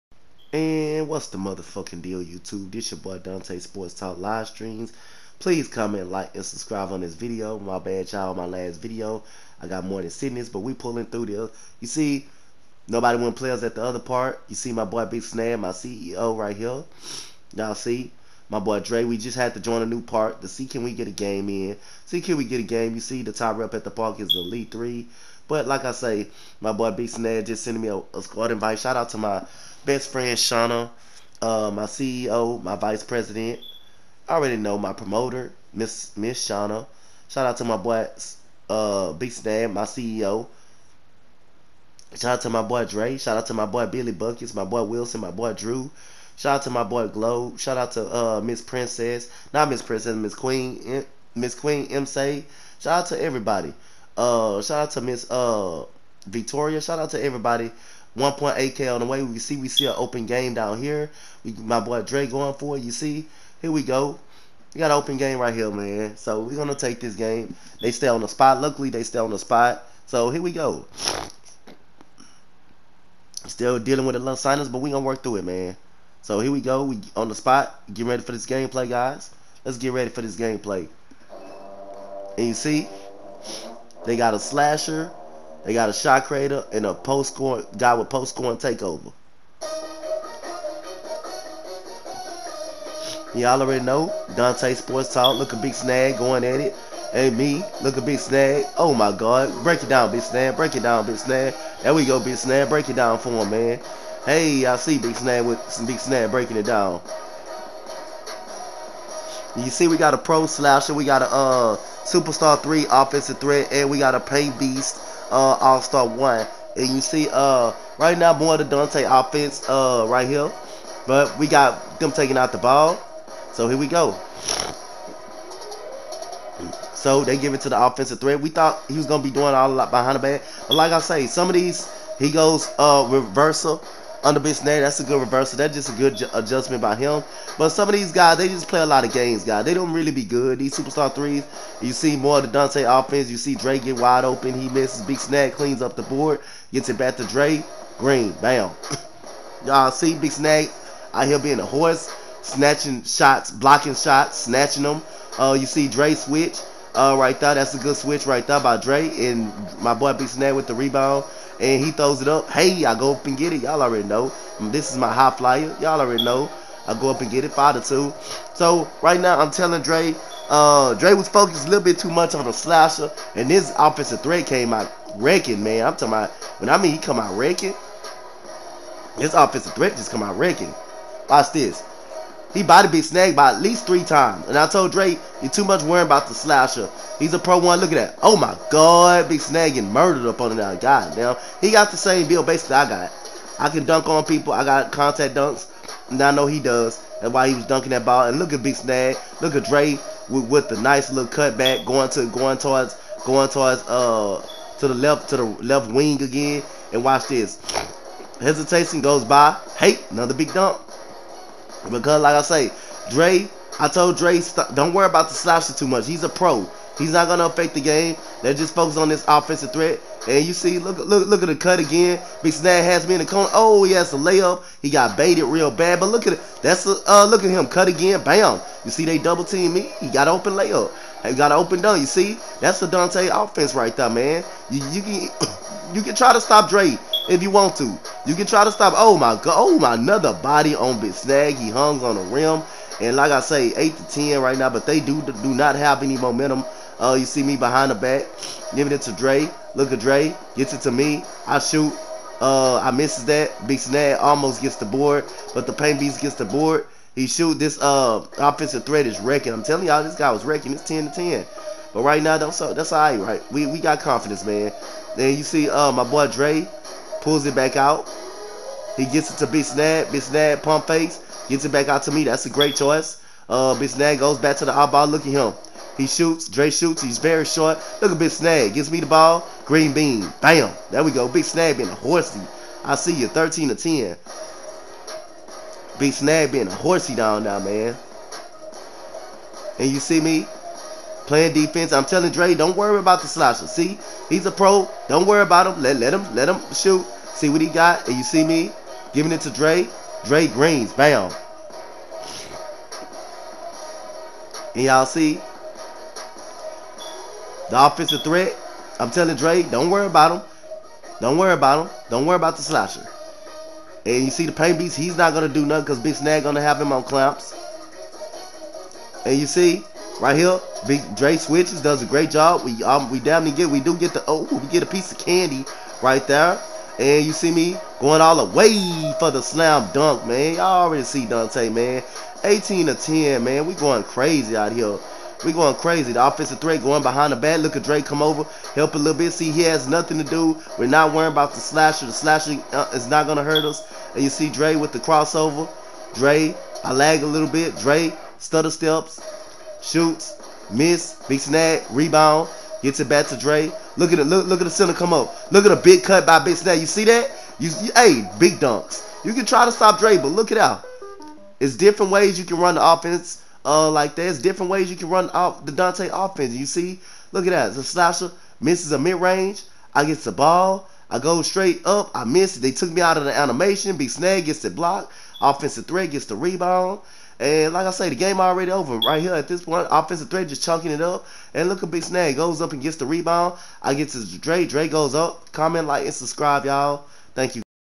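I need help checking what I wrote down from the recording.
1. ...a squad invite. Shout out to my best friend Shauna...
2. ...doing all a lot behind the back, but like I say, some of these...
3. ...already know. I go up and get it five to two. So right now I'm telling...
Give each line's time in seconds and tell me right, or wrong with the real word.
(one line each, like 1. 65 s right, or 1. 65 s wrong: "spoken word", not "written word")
1. 28 s right
2. 129 s right
3. 166 s right.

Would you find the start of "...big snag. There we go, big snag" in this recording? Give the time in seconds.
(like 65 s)
101 s.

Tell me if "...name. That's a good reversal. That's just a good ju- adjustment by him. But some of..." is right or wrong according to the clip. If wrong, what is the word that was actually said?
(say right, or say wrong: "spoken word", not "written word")
right.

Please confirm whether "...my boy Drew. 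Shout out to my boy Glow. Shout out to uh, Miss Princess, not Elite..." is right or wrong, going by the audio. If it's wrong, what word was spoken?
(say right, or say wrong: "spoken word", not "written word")
wrong: "Miss", not "Elite".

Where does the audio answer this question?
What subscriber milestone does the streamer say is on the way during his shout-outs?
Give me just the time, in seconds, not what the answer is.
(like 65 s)
58 s.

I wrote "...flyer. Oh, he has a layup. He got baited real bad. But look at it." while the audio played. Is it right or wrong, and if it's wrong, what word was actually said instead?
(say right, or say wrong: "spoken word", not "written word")
wrong: "corner", not "flyer".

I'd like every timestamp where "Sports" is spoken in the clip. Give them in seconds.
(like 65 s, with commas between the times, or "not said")
3 s, 94 s.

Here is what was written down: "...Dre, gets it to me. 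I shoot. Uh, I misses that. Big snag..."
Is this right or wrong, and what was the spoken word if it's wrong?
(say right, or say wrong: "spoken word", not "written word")
right.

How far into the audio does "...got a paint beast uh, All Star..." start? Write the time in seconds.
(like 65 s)
113 s.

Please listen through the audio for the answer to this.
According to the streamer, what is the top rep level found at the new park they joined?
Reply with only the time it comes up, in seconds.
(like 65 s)
24 s.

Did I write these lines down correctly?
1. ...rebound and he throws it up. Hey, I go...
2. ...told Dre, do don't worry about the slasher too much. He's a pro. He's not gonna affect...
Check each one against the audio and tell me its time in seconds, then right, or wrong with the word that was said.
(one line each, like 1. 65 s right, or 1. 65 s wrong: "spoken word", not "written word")
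1. 160 s right
2. 213 s right.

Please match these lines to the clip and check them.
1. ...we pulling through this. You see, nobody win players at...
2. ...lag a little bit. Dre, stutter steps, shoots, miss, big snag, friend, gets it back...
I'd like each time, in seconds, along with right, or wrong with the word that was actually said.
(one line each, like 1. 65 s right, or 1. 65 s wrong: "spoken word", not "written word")
1. 10 s right
2. 346 s wrong: "rebound", not "friend".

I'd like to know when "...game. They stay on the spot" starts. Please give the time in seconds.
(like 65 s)
67 s.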